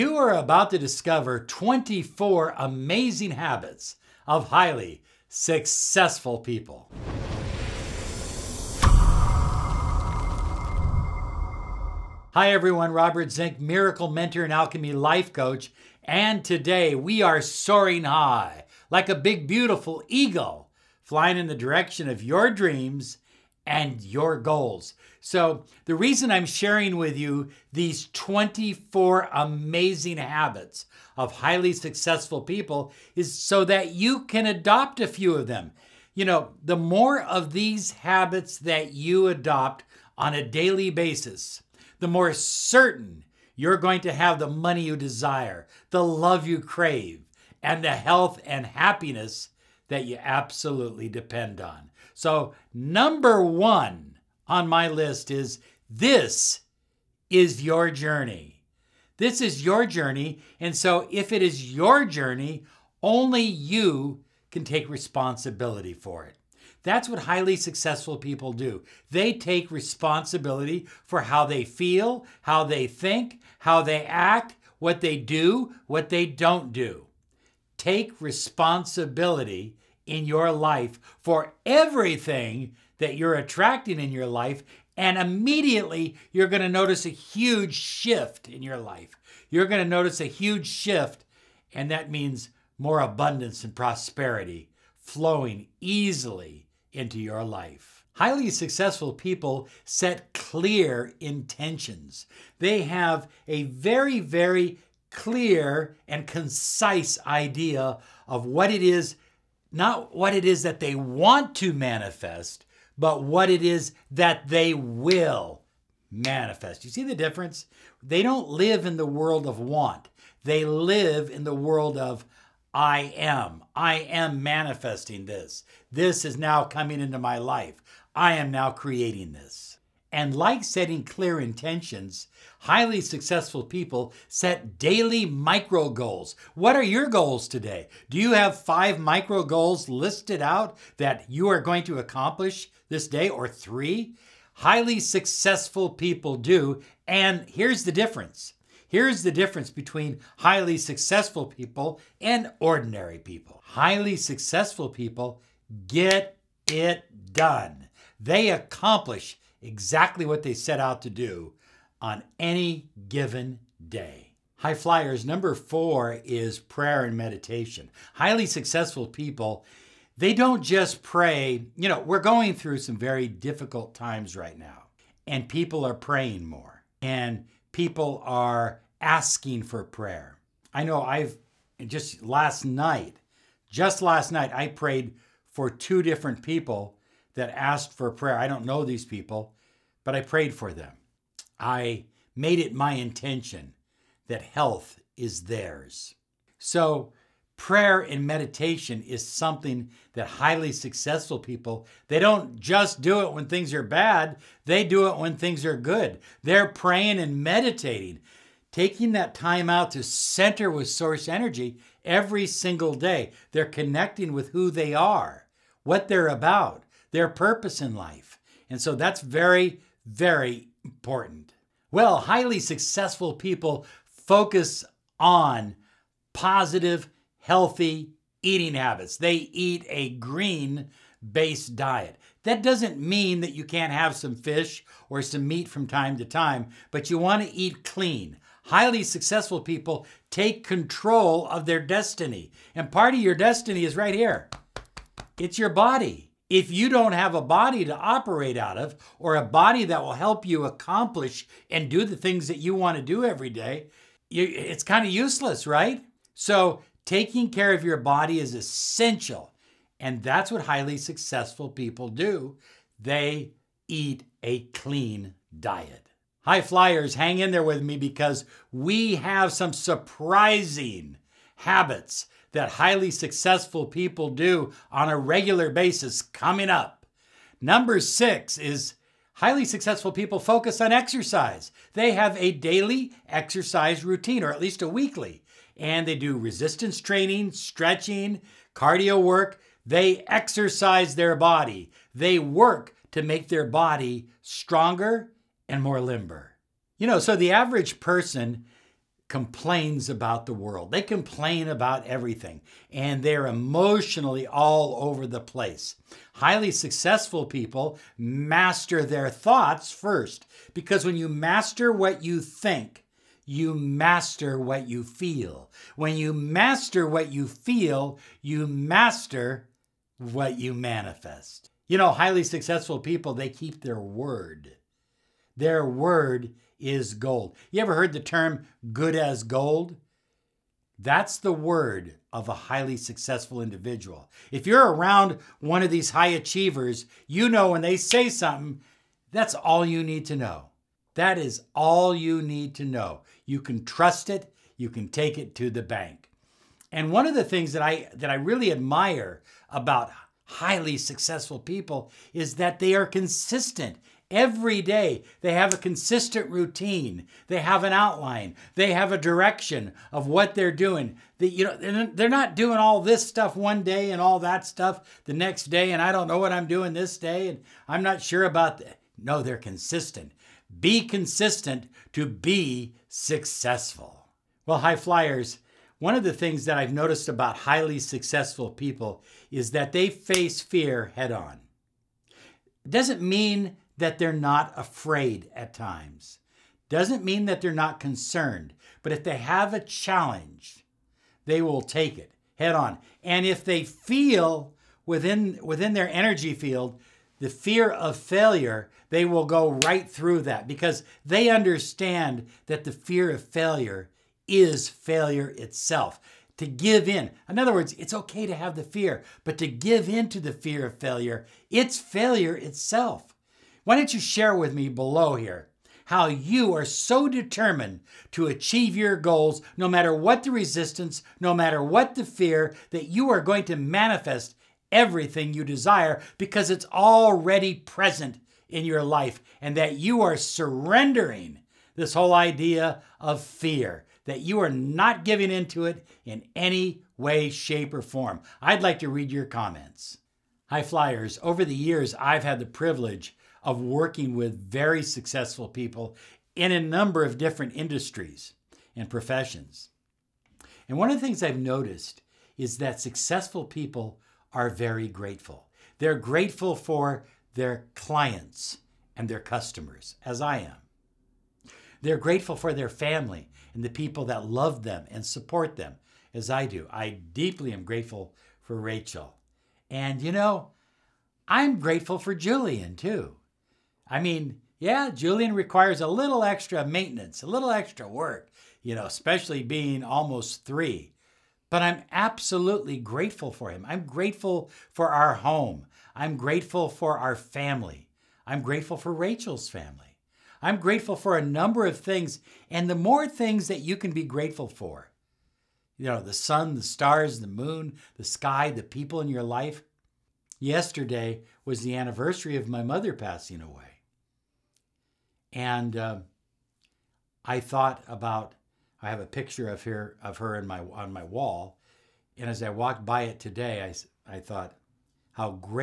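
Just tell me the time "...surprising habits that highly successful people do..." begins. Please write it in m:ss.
4:29.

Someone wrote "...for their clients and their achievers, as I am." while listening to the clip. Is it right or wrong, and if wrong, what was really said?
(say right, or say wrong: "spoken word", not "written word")
wrong: "customers", not "achievers".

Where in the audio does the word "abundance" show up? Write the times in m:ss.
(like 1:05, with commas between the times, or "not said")
1:32.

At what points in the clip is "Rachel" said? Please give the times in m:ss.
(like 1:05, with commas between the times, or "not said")
7:48, 8:09.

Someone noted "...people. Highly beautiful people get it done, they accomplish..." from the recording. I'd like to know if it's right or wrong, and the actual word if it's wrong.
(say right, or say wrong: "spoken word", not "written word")
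wrong: "successful", not "beautiful".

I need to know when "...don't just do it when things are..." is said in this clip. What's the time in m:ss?
3:22.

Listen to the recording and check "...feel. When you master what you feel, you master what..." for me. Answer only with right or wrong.
right.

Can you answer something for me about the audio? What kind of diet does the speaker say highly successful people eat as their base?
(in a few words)
green based diet.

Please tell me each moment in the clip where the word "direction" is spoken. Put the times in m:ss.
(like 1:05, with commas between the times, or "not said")
0:21, 5:59.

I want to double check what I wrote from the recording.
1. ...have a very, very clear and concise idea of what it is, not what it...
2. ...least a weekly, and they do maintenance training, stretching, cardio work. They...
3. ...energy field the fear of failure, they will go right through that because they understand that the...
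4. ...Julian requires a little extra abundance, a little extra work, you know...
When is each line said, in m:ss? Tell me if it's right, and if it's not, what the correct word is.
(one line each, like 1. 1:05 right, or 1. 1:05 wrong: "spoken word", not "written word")
1. 1:42 right
2. 4:44 wrong: "resistance", not "maintenance"
3. 6:36 right
4. 7:55 wrong: "maintenance", not "abundance".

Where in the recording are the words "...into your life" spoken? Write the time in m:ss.
1:36.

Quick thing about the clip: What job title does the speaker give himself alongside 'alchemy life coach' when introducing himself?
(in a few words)
miracle mentor.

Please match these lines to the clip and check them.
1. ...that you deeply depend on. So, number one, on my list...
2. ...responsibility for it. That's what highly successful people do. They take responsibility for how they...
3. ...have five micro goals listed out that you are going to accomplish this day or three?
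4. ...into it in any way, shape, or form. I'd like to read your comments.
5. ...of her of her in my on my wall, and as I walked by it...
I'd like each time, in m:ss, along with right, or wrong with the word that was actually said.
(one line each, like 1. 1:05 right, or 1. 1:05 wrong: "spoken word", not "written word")
1. 0:49 wrong: "absolutely", not "deeply"
2. 1:04 right
3. 2:18 right
4. 7:15 right
5. 8:29 right.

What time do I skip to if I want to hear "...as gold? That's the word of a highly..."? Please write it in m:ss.
5:29.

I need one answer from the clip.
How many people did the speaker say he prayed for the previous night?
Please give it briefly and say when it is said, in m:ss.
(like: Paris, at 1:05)
2, at 3:05.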